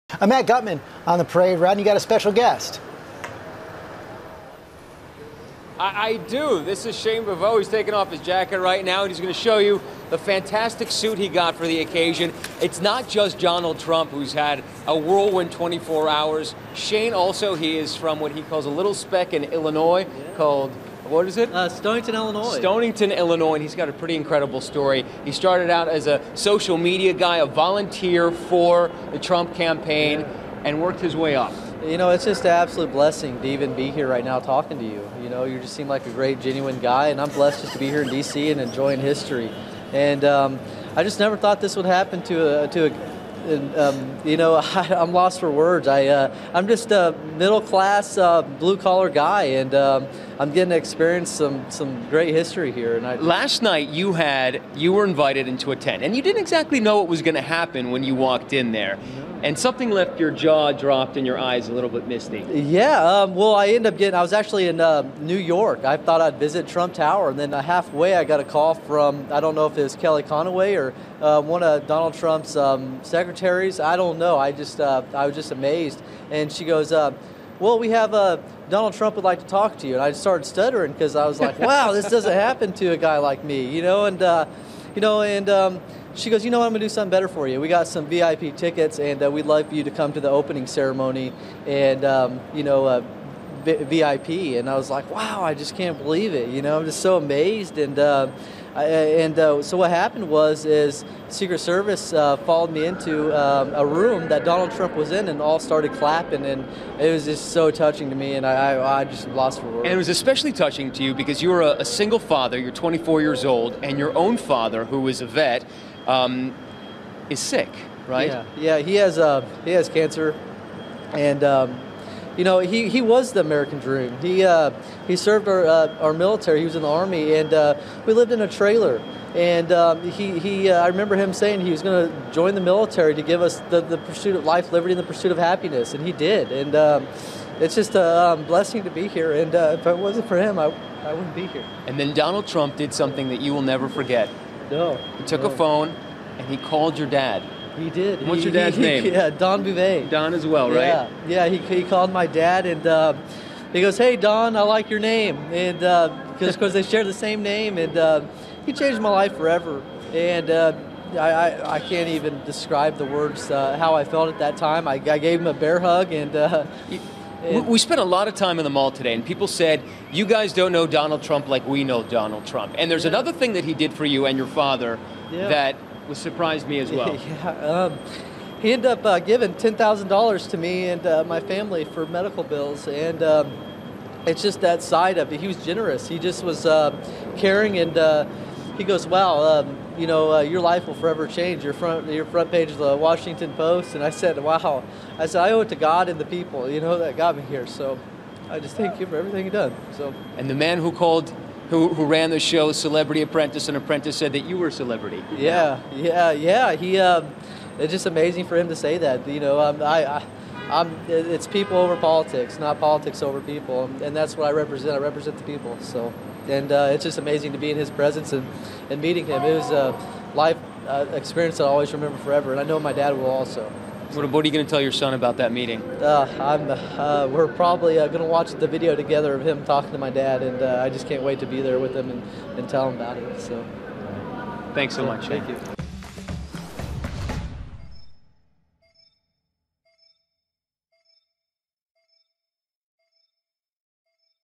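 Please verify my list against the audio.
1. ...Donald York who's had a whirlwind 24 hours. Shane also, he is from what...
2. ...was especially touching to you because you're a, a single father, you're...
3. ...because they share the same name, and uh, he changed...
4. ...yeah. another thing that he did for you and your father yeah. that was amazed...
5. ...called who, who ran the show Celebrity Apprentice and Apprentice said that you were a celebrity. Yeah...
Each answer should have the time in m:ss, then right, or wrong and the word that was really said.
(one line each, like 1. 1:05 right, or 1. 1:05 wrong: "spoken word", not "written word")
1. 0:13 wrong: "Trump", not "York"
2. 1:49 right
3. 2:36 right
4. 2:53 wrong: "surprised", not "amazed"
5. 3:20 right.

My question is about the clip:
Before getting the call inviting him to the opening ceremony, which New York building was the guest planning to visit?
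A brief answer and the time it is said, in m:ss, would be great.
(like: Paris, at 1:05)
Trump Tower, at 1:06.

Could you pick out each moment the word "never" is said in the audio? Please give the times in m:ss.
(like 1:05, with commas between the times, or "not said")
0:41, 2:23.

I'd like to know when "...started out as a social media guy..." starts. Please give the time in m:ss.
0:25.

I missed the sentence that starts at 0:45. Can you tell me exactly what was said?
I, uh, I'm just a middle class, uh, blue collar guy, and um, I'm getting to experience some some great history here.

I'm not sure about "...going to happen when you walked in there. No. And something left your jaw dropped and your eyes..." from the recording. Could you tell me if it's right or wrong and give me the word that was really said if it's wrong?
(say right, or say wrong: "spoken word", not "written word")
right.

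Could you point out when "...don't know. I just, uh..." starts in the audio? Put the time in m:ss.
1:13.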